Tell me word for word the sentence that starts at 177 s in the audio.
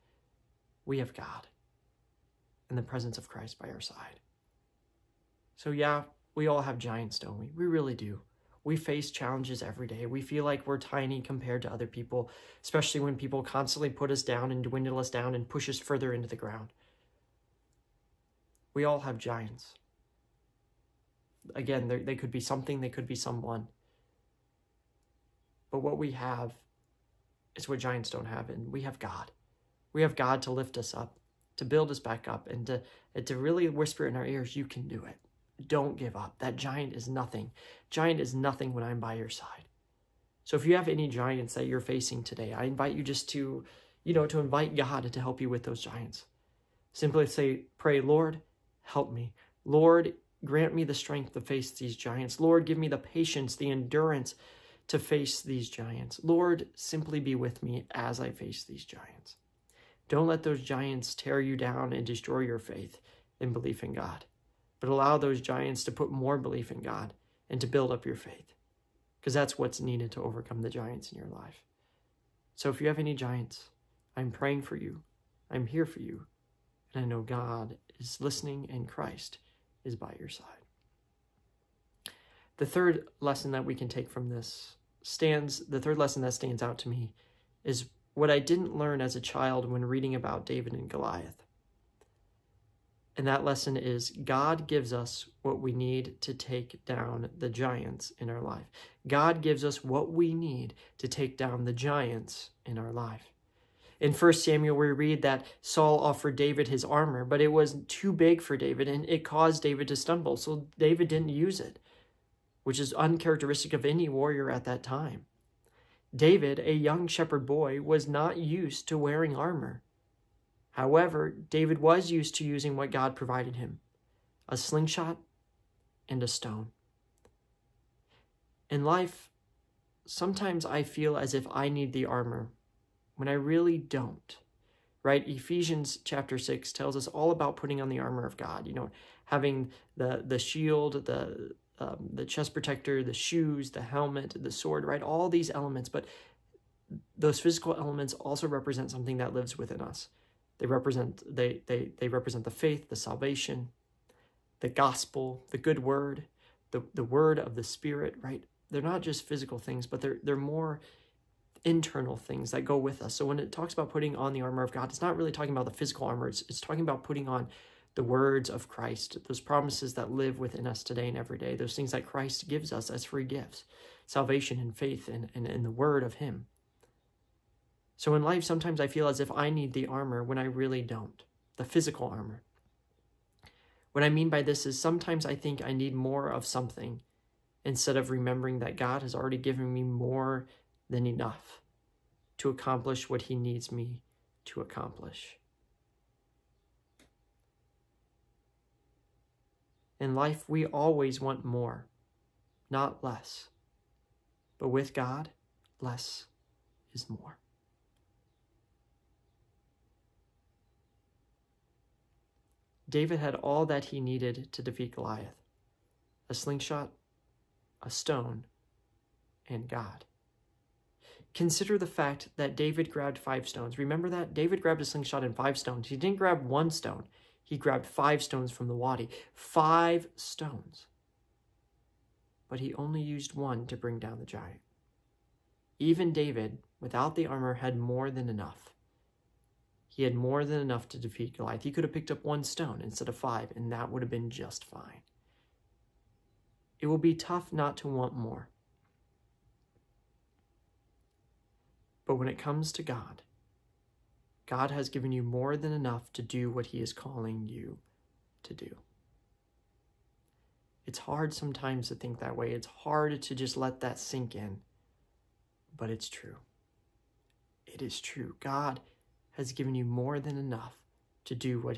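So in life, sometimes I feel as if I need the armor when I really don't, the physical armor.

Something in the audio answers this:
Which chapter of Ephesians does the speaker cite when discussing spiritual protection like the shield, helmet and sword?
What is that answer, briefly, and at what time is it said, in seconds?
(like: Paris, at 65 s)
Ephesians chapter 6, at 135 s.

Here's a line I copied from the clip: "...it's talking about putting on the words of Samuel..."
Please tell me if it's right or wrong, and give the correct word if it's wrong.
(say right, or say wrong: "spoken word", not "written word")
wrong: "Christ", not "Samuel".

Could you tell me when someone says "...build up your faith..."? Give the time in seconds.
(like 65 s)
67 s.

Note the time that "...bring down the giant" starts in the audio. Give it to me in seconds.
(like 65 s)
233 s.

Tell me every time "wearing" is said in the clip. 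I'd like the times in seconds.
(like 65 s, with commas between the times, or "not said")
118 s.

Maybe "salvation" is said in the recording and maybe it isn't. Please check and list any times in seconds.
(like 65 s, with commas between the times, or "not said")
152 s, 174 s.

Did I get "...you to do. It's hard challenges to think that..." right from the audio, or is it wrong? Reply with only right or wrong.
wrong.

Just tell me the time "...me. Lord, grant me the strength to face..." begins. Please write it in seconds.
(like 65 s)
49 s.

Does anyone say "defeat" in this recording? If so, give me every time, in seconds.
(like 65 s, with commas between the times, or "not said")
214 s, 240 s.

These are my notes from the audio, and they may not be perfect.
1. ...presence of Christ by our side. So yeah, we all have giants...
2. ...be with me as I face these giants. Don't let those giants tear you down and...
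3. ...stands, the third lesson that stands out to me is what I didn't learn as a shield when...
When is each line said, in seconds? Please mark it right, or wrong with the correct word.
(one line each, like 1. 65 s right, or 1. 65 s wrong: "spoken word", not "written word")
1. 2 s right
2. 57 s right
3. 85 s wrong: "child", not "shield".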